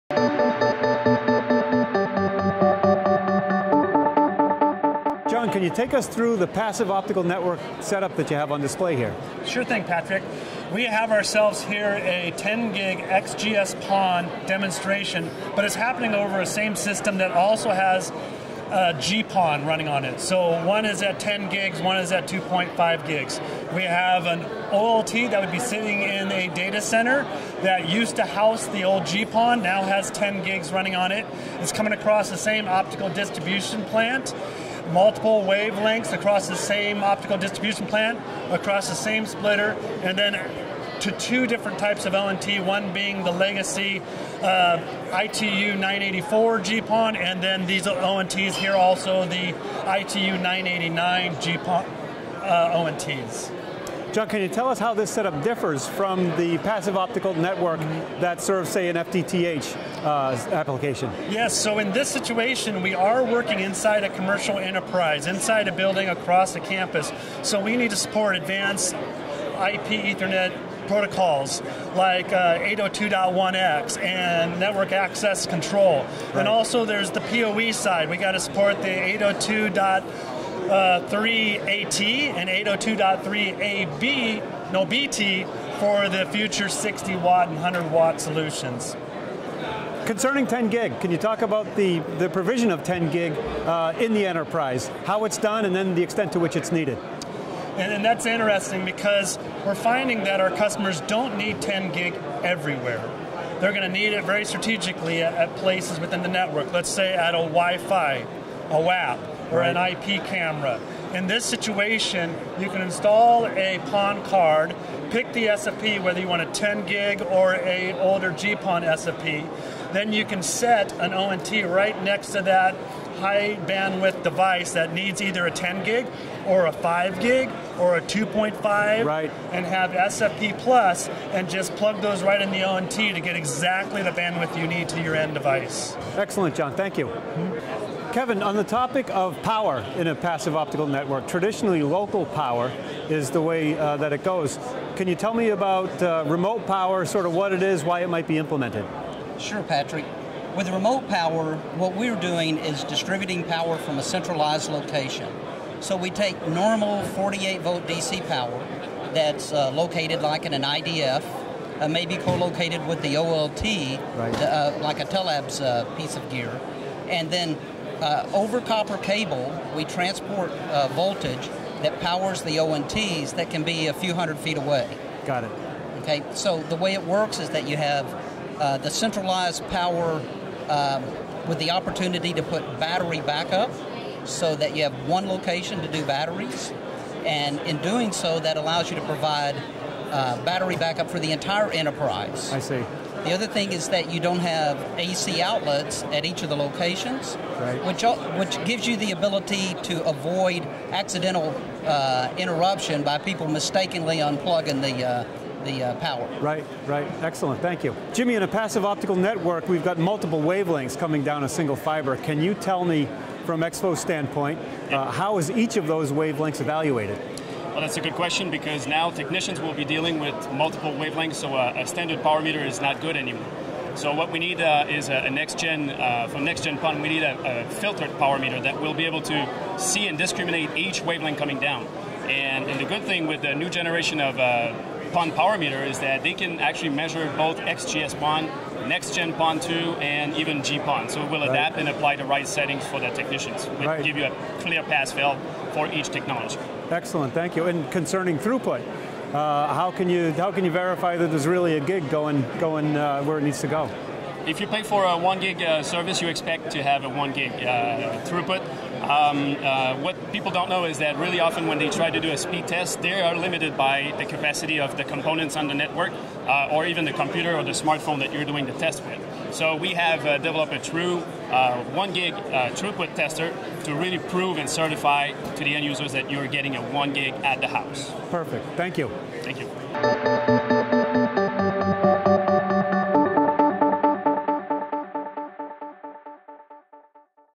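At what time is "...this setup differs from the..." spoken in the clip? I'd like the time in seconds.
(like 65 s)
54 s.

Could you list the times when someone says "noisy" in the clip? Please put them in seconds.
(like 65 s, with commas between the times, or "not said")
not said.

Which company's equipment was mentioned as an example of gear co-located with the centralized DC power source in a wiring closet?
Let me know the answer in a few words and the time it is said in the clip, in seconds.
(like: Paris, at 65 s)
Tellabs, at 165 s.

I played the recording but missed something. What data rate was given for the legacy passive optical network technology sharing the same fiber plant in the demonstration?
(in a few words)
2.5 gigs.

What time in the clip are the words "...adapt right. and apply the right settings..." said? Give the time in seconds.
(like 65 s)
241 s.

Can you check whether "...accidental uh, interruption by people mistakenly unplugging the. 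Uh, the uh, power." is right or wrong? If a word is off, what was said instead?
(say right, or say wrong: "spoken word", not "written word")
right.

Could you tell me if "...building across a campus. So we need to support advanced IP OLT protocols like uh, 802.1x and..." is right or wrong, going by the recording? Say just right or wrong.
wrong.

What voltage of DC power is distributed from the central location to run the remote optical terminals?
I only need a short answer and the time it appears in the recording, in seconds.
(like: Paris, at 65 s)
48 volt, at 157 s.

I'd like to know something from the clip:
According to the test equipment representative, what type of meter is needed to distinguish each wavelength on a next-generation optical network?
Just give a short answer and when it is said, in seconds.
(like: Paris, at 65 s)
filtered power meter, at 227 s.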